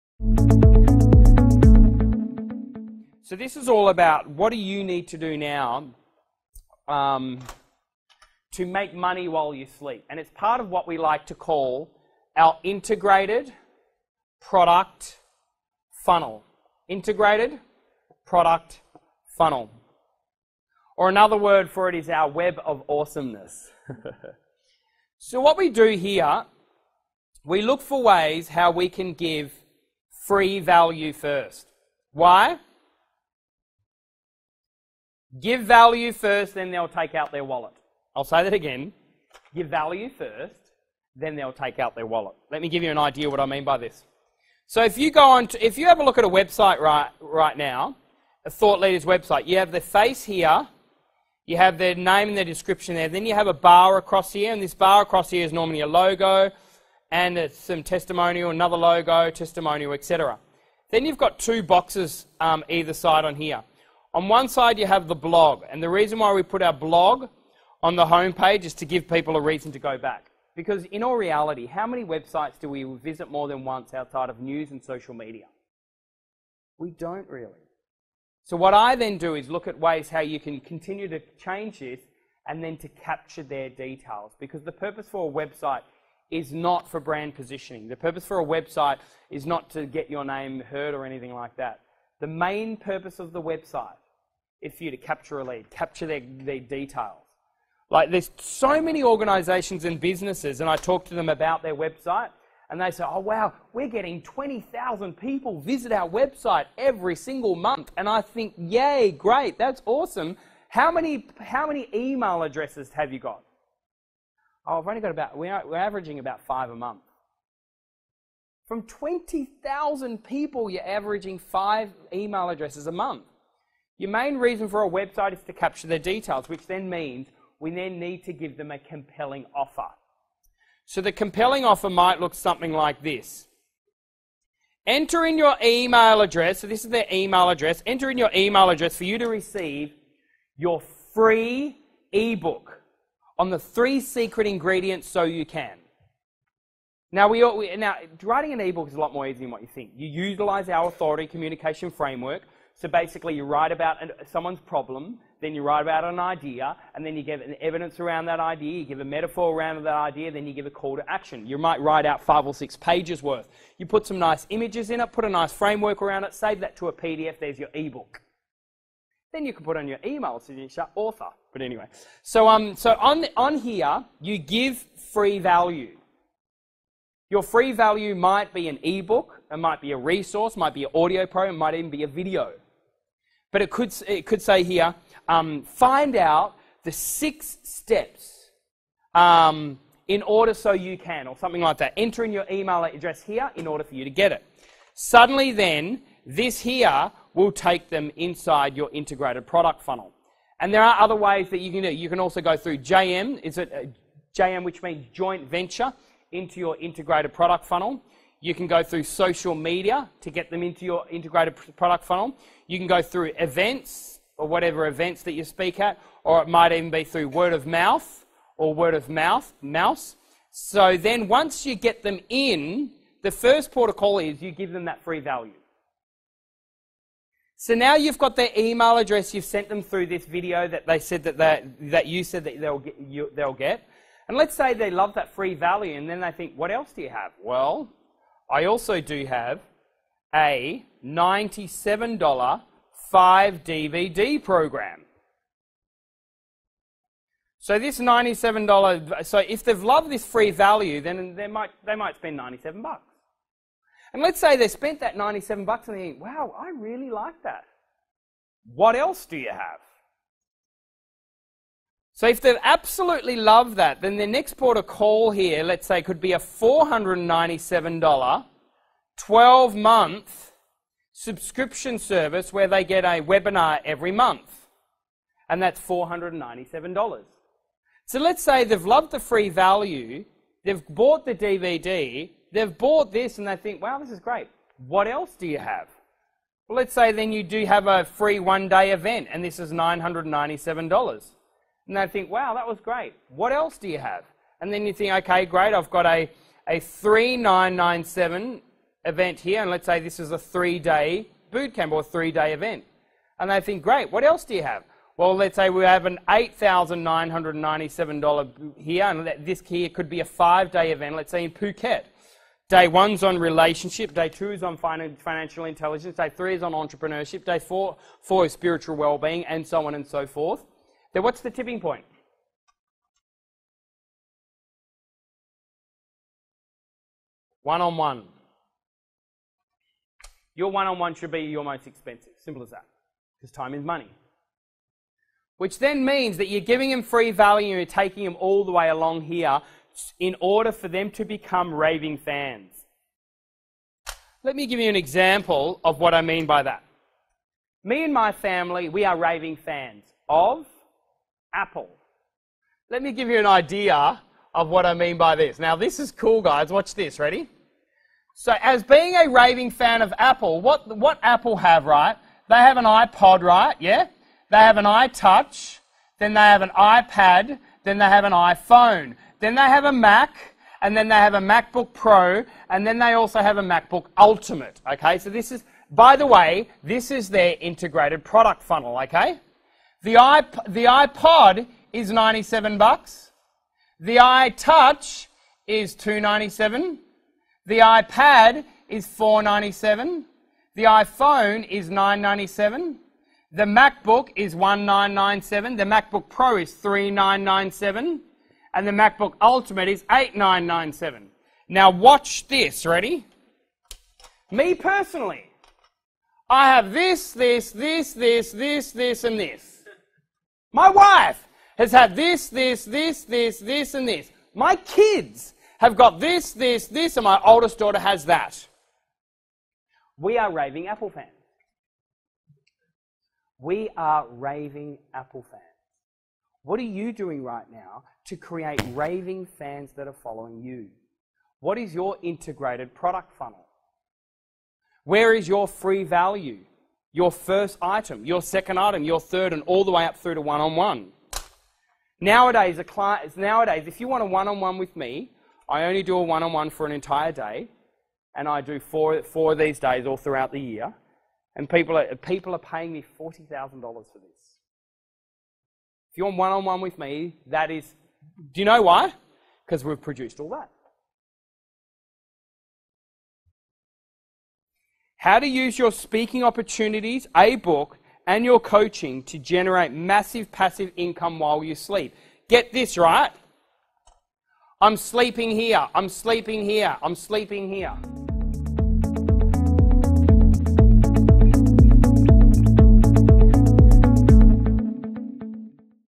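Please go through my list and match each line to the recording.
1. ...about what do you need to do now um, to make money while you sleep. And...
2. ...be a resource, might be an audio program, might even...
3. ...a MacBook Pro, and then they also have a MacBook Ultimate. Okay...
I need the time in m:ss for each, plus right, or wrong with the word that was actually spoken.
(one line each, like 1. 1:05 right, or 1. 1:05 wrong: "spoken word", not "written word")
1. 0:03 right
2. 2:59 right
3. 6:11 right.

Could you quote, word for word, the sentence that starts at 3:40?
So then once you get them in, the first protocol is you give them that free value.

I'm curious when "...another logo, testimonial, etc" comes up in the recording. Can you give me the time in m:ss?
0:58.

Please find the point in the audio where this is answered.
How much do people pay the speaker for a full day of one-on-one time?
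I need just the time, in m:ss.
7:33.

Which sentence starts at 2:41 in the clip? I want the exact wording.
You might write out five or six pages worth.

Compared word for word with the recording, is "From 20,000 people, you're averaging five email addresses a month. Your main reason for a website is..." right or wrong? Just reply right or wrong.
right.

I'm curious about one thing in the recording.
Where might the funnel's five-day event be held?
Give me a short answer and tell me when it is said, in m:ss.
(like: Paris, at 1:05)
Phuket, at 5:11.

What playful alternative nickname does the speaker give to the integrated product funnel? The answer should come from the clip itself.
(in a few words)
web of awesomeness.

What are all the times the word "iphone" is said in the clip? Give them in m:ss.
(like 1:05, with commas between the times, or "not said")
6:08, 6:30.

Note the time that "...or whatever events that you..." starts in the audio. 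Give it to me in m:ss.
3:34.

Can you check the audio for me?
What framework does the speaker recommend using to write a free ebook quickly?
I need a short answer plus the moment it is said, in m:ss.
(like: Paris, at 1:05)
authority communication framework, at 2:30.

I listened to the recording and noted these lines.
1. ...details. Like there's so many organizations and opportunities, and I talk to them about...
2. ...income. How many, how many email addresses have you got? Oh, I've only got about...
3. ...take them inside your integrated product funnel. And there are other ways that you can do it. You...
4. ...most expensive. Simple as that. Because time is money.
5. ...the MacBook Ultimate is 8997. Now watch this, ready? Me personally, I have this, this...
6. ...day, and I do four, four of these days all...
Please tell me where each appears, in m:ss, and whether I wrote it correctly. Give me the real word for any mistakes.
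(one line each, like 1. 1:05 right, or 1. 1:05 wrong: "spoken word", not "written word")
1. 1:36 wrong: "businesses", not "opportunities"
2. 1:49 wrong: "awesome", not "income"
3. 3:17 right
4. 5:31 right
5. 6:38 right
6. 7:27 right.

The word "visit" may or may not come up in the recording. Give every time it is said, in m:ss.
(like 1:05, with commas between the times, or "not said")
1:12, 1:45.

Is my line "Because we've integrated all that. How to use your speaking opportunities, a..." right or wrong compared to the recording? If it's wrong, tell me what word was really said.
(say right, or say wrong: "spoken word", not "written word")
wrong: "produced", not "integrated".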